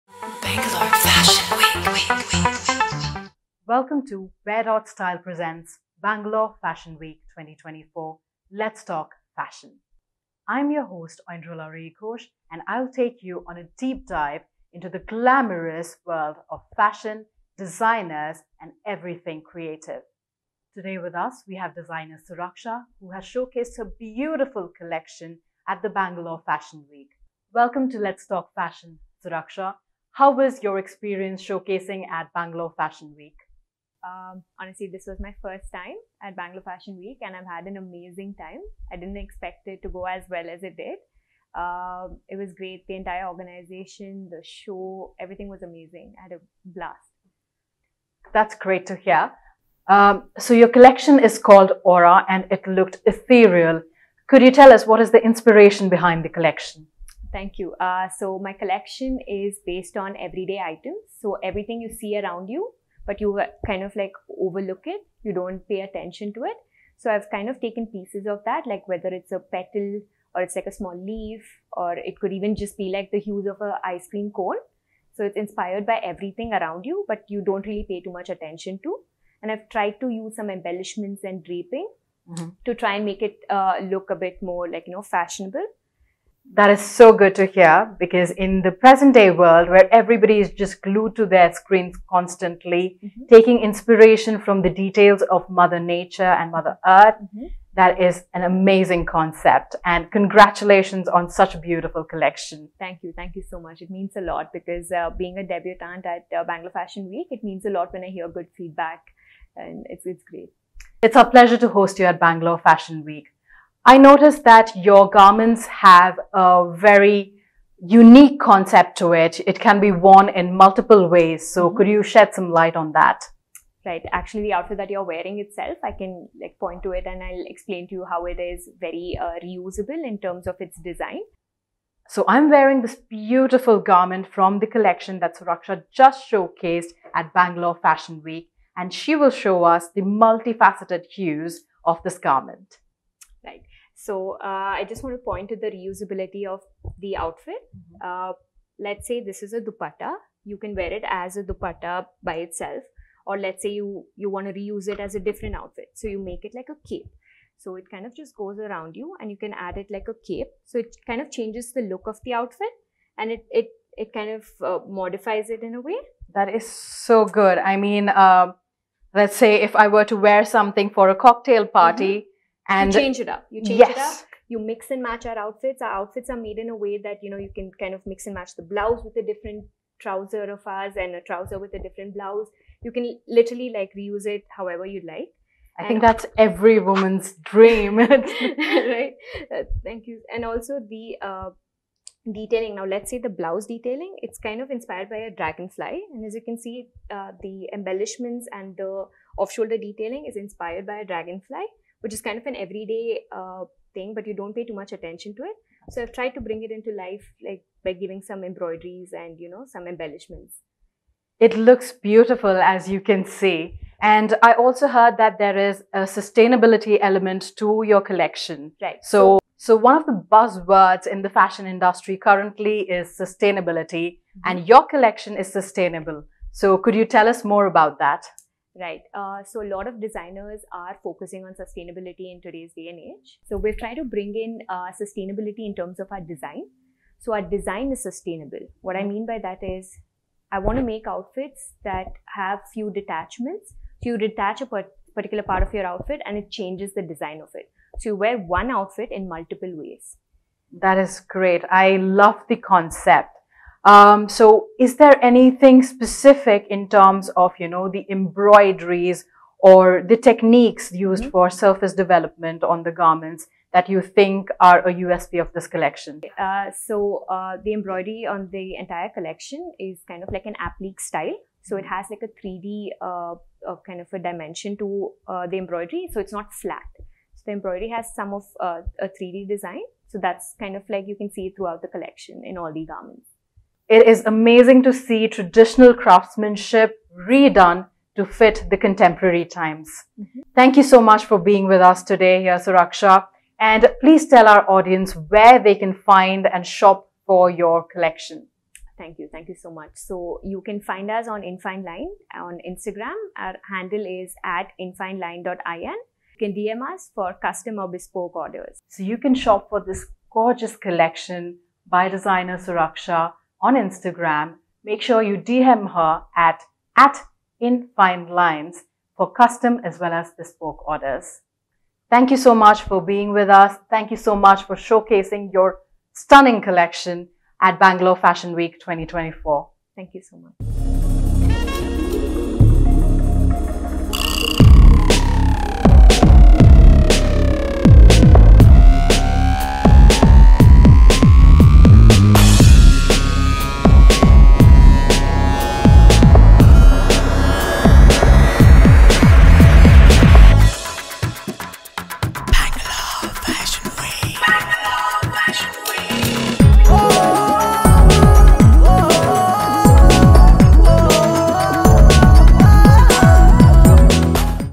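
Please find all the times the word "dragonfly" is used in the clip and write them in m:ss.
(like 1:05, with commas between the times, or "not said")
3:15, 3:21.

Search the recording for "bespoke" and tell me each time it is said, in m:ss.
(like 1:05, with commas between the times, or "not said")
5:07, 5:20.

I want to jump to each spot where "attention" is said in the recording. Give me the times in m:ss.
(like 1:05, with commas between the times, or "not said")
1:05, 1:18, 3:24.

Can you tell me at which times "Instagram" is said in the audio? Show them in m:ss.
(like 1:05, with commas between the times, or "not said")
5:02, 5:13.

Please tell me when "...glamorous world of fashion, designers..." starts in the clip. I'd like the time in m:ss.
0:14.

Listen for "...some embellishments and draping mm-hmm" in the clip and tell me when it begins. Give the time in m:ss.
1:20.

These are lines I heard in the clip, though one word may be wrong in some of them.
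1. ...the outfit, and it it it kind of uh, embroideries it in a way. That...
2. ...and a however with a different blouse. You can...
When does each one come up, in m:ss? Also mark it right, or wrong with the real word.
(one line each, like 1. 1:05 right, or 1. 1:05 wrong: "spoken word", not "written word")
1. 2:42 wrong: "modifies", not "embroideries"
2. 3:00 wrong: "trouser", not "however".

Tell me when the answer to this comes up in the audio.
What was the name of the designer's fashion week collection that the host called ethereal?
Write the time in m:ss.
0:51.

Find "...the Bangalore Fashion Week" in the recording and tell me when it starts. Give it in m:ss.
0:25.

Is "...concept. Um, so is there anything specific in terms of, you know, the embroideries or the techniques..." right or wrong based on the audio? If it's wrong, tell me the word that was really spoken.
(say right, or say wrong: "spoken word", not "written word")
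right.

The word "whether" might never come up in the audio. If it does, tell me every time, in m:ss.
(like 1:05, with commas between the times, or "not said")
1:08.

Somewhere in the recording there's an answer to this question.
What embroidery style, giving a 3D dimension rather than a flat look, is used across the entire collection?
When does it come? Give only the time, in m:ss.
4:30.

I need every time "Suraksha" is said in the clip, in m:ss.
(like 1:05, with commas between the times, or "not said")
0:22, 0:29, 2:15, 4:52, 5:12.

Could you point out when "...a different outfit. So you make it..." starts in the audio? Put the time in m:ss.
2:35.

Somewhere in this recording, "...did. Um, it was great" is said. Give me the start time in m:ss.
0:40.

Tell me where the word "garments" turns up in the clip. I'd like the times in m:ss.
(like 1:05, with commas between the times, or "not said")
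1:55, 2:13, 2:22, 4:22, 4:42.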